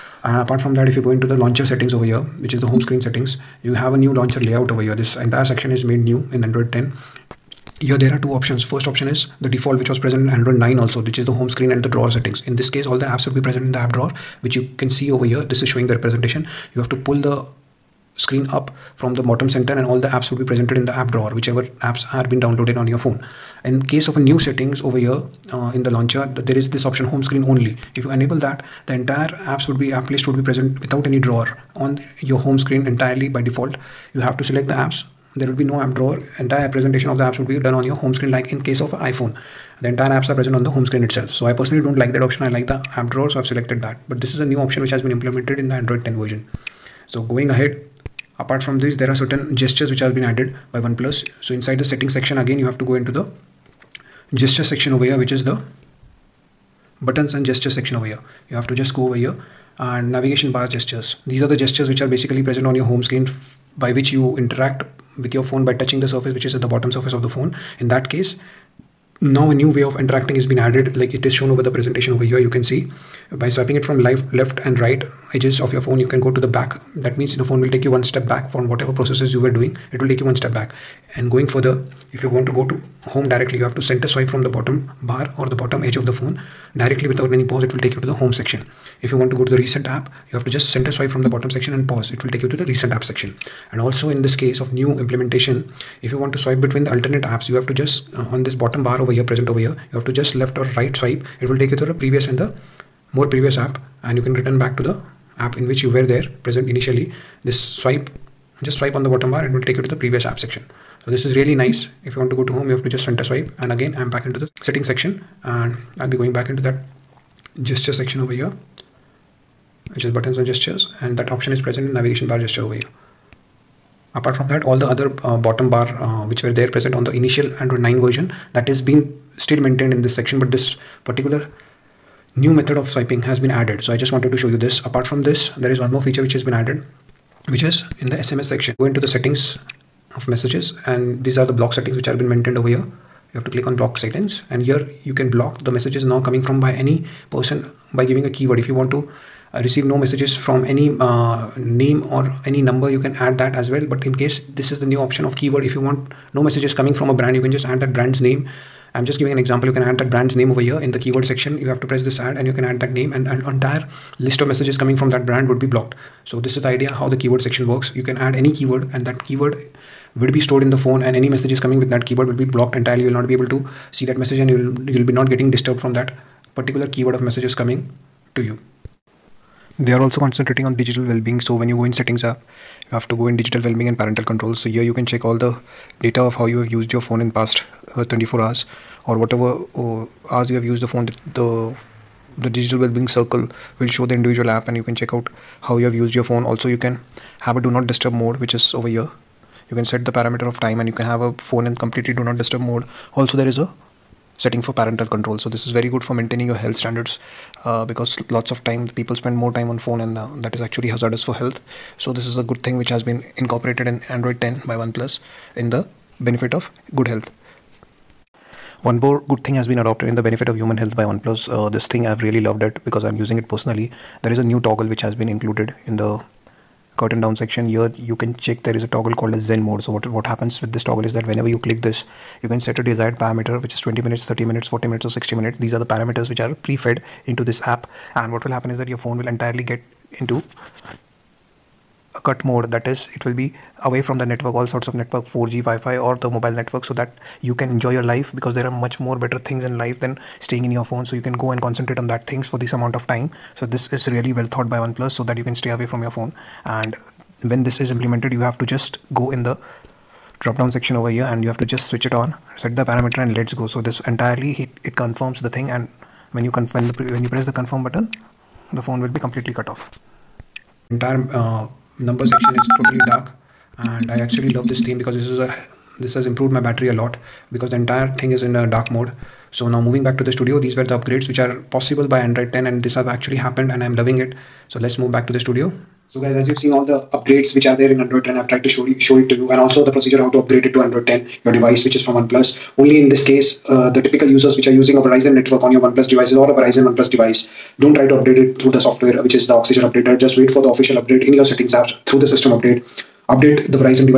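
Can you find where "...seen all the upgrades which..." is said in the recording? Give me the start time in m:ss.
4:46.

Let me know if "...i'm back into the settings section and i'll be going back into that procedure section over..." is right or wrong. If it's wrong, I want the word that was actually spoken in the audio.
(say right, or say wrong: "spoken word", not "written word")
wrong: "gesture", not "procedure".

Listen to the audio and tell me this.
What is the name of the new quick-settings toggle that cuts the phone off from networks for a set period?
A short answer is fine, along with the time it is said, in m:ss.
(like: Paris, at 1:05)
Zen mode, at 3:49.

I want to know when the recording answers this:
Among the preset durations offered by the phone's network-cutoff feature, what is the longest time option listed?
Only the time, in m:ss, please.
3:55.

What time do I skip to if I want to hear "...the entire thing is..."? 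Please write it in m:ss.
4:37.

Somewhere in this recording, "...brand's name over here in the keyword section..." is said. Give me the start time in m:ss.
2:40.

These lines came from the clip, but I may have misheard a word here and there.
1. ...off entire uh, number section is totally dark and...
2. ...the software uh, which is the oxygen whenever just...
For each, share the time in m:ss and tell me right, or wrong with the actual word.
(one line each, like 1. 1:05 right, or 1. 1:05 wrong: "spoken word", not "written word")
1. 4:29 right
2. 4:58 wrong: "updater", not "whenever".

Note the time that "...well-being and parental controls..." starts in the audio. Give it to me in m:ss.
3:03.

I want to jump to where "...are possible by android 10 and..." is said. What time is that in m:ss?
4:41.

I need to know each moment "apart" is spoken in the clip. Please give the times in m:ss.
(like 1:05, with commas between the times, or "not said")
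0:00, 0:48, 2:04, 2:14.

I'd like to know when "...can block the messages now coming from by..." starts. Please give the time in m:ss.
2:25.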